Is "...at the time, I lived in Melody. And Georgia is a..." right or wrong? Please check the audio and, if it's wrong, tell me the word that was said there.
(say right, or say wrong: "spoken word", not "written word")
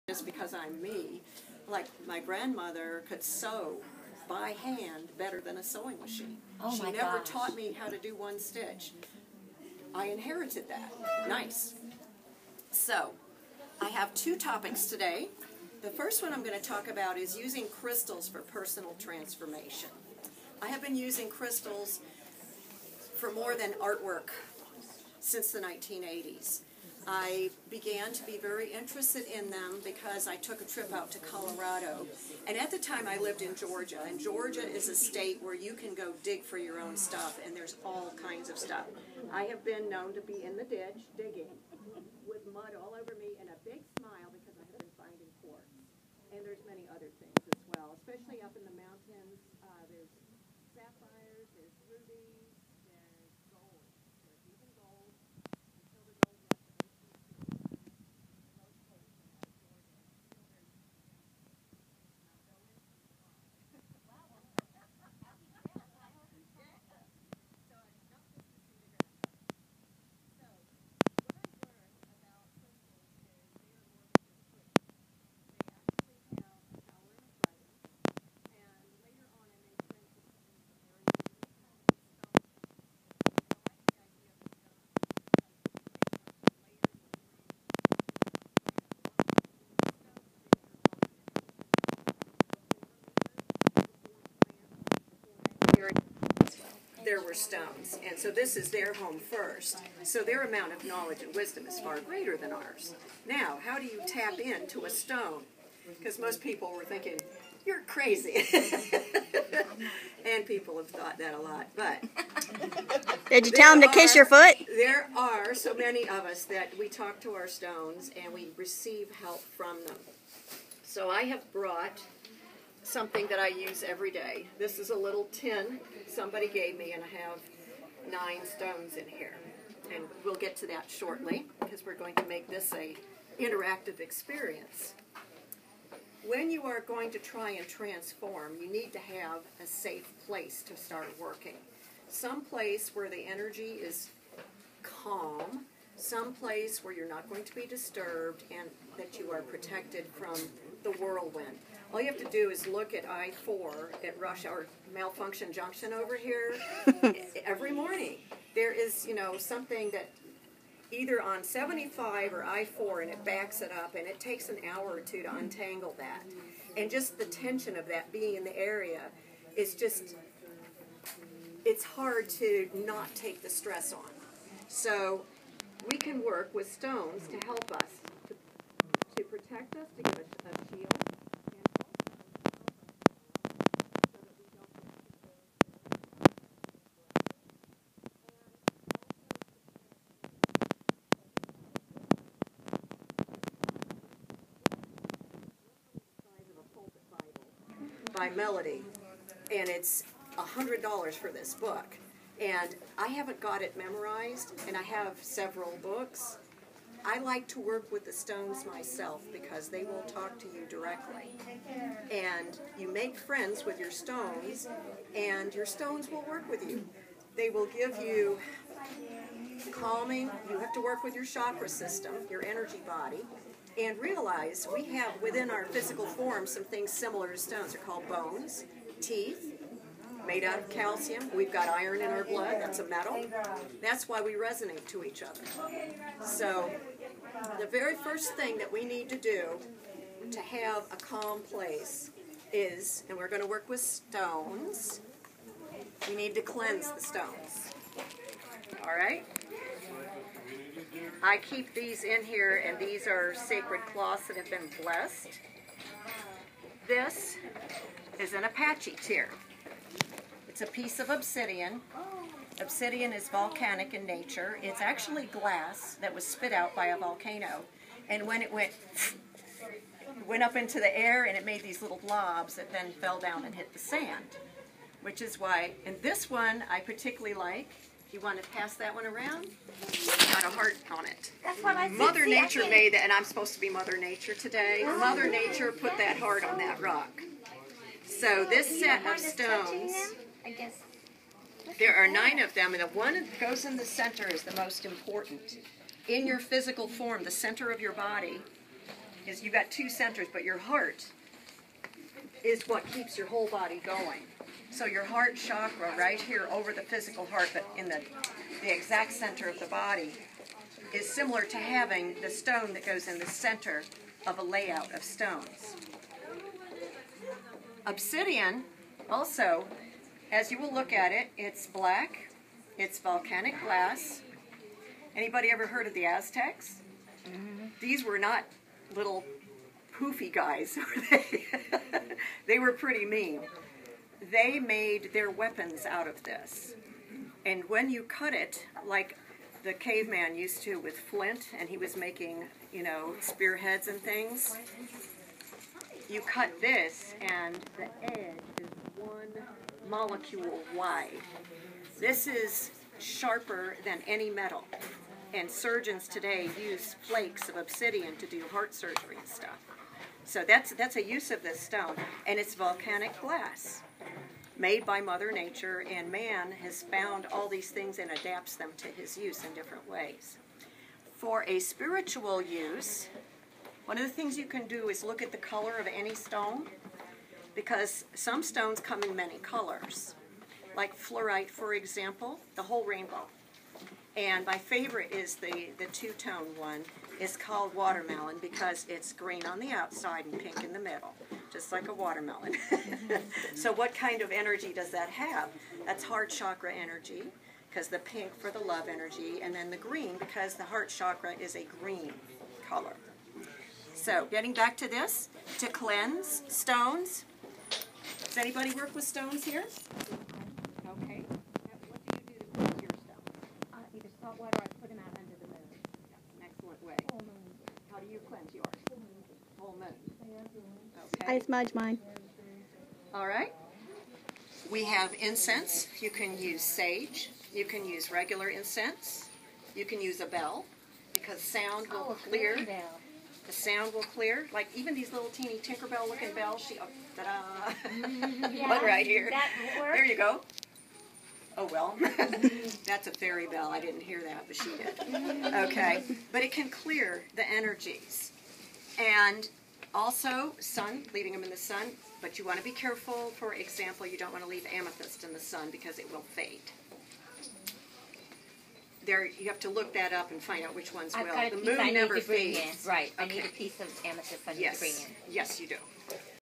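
wrong: "Georgia", not "Melody".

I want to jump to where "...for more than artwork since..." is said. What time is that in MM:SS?
00:23.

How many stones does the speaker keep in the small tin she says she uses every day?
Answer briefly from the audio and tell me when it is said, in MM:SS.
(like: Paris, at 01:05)
9, at 02:08.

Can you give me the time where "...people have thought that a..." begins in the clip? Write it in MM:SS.
01:50.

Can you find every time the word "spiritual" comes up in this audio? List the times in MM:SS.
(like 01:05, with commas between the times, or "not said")
06:11.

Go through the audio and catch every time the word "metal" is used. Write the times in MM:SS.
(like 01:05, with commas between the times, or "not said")
03:52, 05:54.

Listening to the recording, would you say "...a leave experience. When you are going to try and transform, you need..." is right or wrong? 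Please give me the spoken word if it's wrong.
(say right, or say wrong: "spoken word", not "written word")
wrong: "interactive", not "leave".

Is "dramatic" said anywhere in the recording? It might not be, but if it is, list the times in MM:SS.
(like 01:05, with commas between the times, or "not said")
not said.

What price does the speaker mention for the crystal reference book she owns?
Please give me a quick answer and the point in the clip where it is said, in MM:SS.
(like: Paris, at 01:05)
$100, at 03:20.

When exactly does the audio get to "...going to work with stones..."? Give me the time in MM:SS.
04:03.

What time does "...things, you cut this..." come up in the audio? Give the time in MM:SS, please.
05:43.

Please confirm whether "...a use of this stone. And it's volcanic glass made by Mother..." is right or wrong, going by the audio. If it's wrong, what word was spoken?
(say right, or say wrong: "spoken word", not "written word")
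right.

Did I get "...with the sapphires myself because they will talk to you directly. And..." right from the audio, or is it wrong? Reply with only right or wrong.
wrong.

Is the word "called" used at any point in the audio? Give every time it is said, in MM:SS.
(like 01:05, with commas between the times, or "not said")
03:47, 06:27.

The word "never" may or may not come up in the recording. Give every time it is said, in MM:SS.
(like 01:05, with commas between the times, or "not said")
00:06, 07:41.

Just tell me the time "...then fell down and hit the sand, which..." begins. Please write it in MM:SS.
04:32.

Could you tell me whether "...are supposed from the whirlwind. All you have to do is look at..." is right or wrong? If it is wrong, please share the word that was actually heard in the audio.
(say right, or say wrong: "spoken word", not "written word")
wrong: "protected", not "supposed".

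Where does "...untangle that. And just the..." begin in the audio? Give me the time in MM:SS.
02:45.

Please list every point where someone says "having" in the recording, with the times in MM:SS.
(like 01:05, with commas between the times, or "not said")
05:11.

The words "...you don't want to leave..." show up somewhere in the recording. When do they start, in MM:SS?
07:34.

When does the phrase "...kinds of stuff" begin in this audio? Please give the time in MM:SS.
00:38.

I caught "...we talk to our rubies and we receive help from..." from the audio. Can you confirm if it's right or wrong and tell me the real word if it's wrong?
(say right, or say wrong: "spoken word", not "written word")
wrong: "stones", not "rubies".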